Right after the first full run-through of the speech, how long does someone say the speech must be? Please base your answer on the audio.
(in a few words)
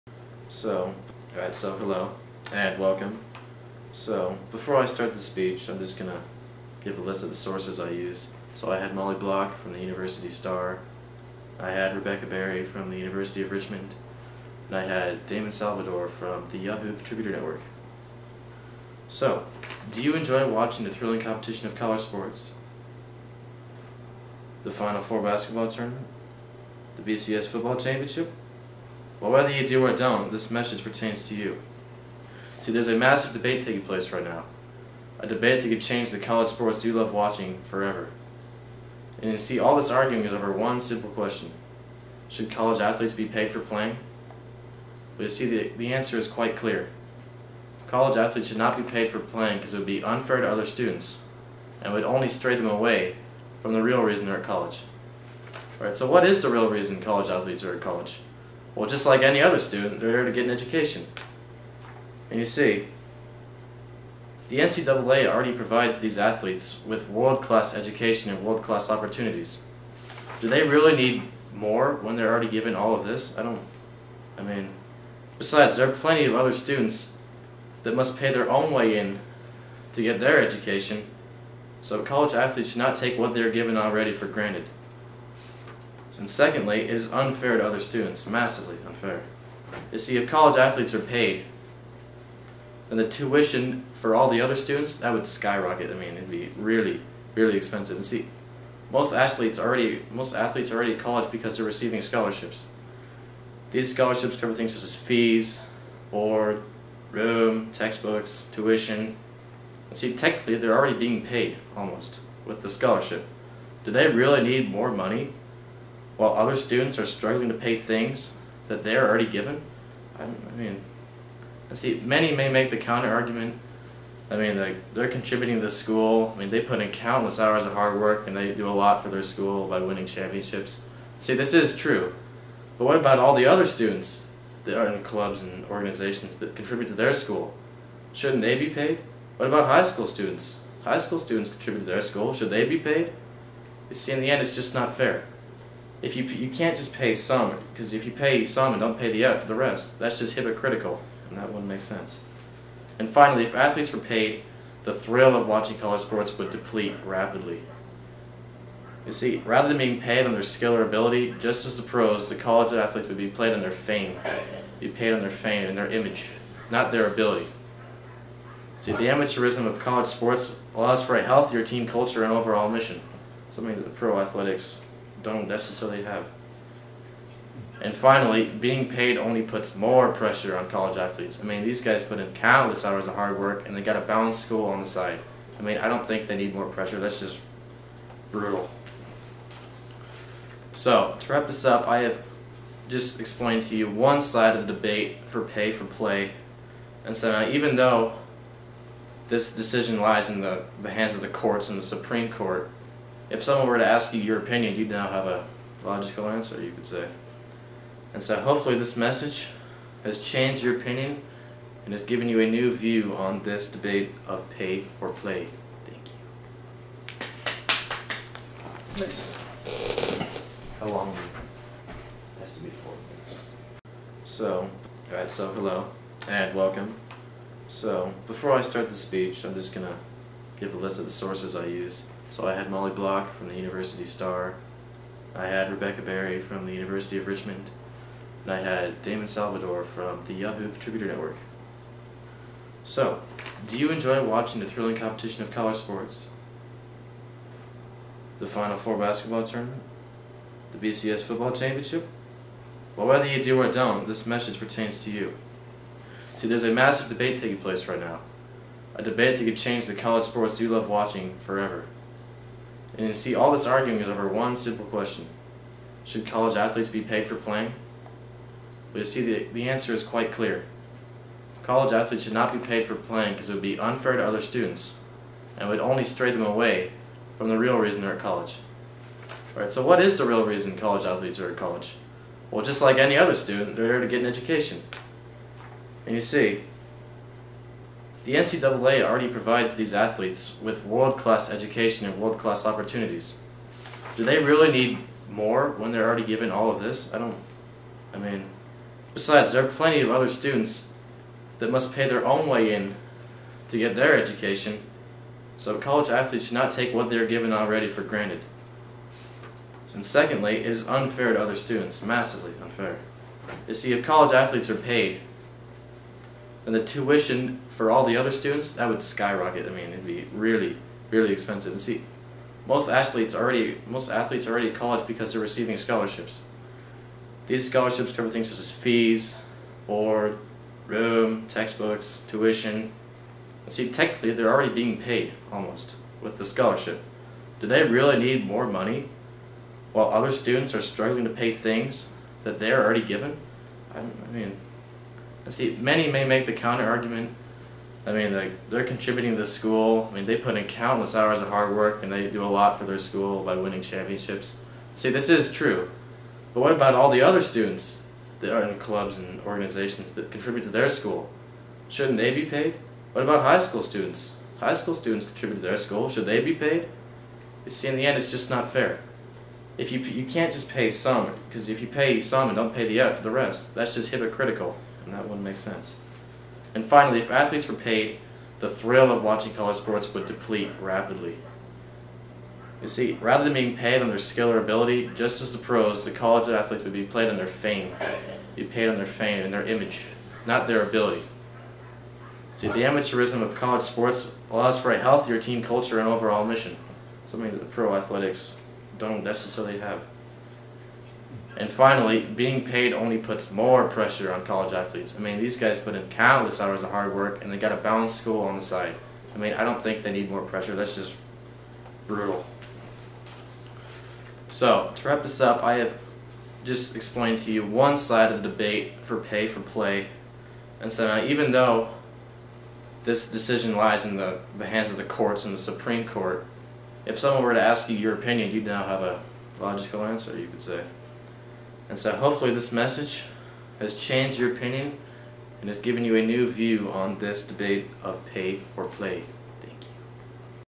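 4 minutes.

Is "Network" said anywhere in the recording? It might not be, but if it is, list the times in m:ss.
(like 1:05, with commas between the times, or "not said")
0:17, 4:01.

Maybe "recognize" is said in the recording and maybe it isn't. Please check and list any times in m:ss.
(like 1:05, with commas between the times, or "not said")
not said.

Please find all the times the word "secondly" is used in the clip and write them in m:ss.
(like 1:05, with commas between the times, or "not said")
1:26, 5:10.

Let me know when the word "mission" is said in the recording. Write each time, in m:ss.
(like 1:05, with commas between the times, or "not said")
2:52, 6:36.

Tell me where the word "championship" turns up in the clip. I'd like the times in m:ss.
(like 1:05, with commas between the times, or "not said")
0:27, 2:10, 4:11, 5:53.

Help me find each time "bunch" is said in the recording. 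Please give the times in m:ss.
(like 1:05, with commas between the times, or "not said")
not said.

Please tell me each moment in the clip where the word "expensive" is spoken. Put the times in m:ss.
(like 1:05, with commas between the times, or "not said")
1:37, 5:21.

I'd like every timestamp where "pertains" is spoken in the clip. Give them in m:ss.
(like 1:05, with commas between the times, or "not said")
0:30, 4:14.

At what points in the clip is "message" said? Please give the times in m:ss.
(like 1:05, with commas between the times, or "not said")
0:30, 3:28, 4:14, 7:12.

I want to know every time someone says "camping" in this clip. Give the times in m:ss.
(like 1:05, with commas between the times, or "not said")
not said.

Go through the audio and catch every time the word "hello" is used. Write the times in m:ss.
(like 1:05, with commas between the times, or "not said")
0:01, 3:45.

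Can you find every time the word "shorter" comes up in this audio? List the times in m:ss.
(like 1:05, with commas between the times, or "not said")
not said.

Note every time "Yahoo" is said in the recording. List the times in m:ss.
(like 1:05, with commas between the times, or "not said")
0:16, 4:00.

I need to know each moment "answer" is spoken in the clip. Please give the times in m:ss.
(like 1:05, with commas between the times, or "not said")
0:45, 3:26, 4:29, 7:10.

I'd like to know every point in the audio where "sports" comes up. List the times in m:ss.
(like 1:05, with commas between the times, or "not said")
0:22, 0:36, 2:36, 2:50, 4:05, 4:20, 6:19, 6:33.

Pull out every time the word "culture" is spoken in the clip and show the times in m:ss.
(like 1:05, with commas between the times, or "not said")
2:51, 6:35.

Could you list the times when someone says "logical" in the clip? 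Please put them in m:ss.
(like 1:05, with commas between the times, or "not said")
3:25, 7:09.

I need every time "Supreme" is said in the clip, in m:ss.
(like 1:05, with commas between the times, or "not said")
3:21, 7:05.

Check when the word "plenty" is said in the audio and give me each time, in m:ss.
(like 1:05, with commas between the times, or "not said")
1:15, 4:59.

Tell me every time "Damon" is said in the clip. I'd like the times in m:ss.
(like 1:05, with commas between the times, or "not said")
0:15, 3:59.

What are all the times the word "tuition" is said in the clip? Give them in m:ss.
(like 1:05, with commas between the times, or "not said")
1:33, 1:48, 5:16, 5:32.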